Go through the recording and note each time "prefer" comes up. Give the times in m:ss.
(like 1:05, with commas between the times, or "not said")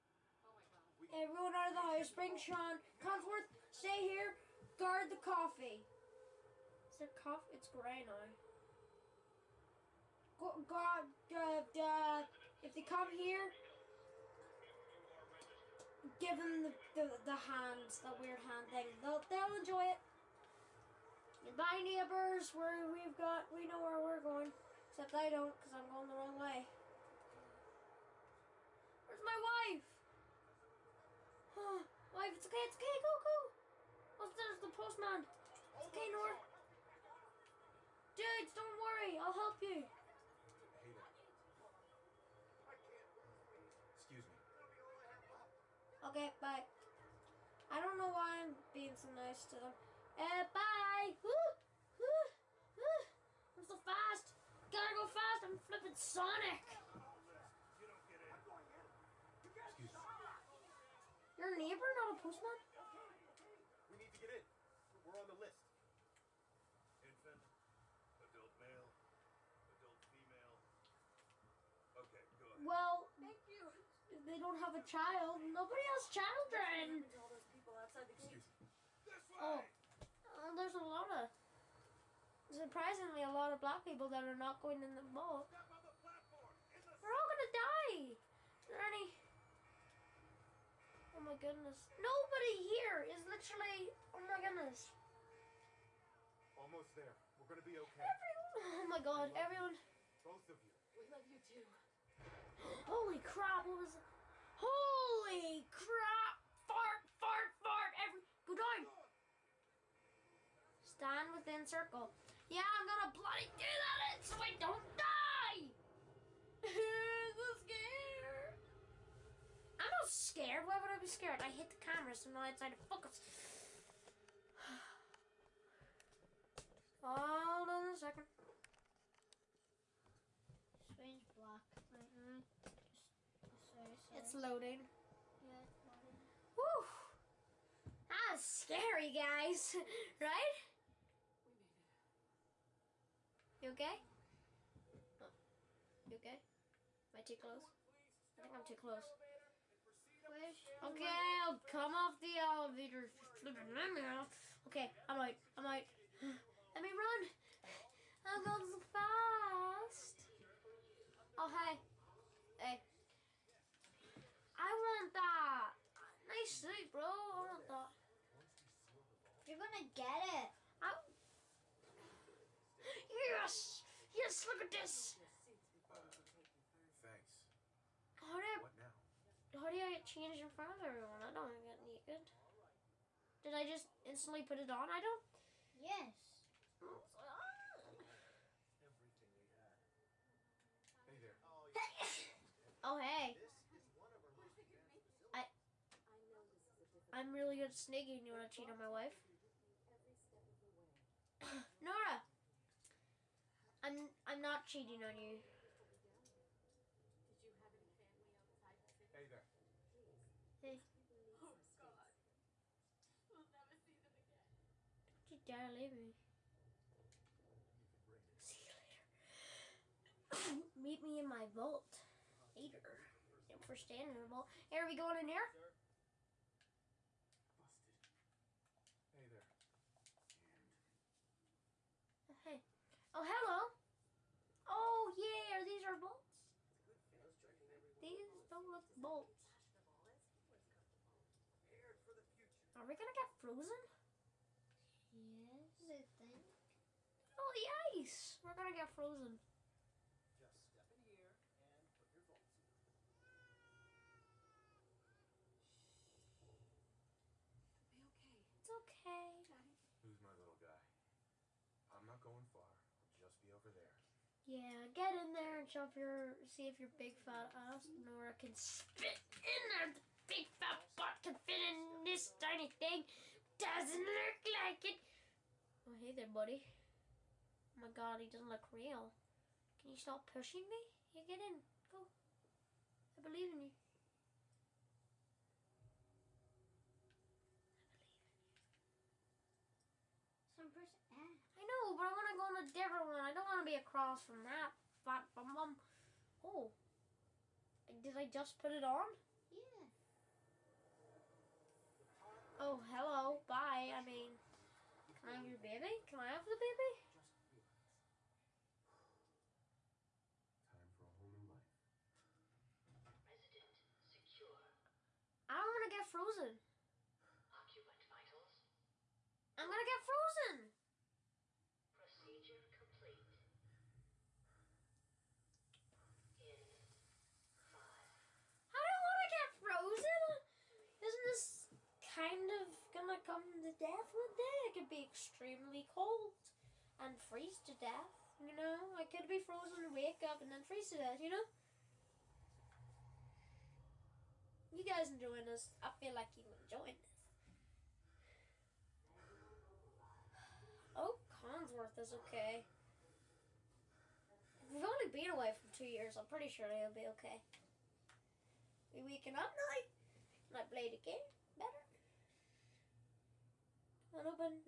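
not said.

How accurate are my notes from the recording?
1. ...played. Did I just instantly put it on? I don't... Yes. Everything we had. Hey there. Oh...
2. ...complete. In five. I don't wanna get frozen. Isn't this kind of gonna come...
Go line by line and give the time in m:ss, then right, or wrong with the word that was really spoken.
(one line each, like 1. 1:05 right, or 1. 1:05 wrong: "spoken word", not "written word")
1. 3:01 wrong: "naked", not "played"
2. 5:22 right.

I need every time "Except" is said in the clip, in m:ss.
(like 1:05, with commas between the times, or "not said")
0:24.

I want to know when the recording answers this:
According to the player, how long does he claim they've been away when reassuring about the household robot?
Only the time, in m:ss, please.
5:55.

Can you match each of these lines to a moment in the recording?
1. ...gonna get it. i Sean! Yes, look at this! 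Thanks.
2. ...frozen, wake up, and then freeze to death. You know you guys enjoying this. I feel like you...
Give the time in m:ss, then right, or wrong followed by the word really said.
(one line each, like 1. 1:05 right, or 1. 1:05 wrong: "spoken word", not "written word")
1. 2:49 wrong: "Yes", not "Sean"
2. 5:39 right.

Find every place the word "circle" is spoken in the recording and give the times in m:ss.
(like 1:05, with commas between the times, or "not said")
1:51.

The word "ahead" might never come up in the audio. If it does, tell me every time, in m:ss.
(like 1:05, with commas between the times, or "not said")
1:12.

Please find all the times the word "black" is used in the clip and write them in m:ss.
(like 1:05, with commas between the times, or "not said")
1:23, 2:11.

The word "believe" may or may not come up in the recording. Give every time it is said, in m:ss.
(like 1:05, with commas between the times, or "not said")
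4:43, 4:47.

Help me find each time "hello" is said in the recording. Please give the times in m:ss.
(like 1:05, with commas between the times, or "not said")
3:53, 5:02.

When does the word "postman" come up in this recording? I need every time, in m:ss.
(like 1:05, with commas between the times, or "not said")
0:34, 1:02.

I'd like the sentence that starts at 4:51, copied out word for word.
I know, but I want to go on a different one.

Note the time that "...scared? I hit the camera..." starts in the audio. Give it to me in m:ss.
2:01.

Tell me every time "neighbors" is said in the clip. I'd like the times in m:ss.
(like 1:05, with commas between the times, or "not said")
0:21, 1:01.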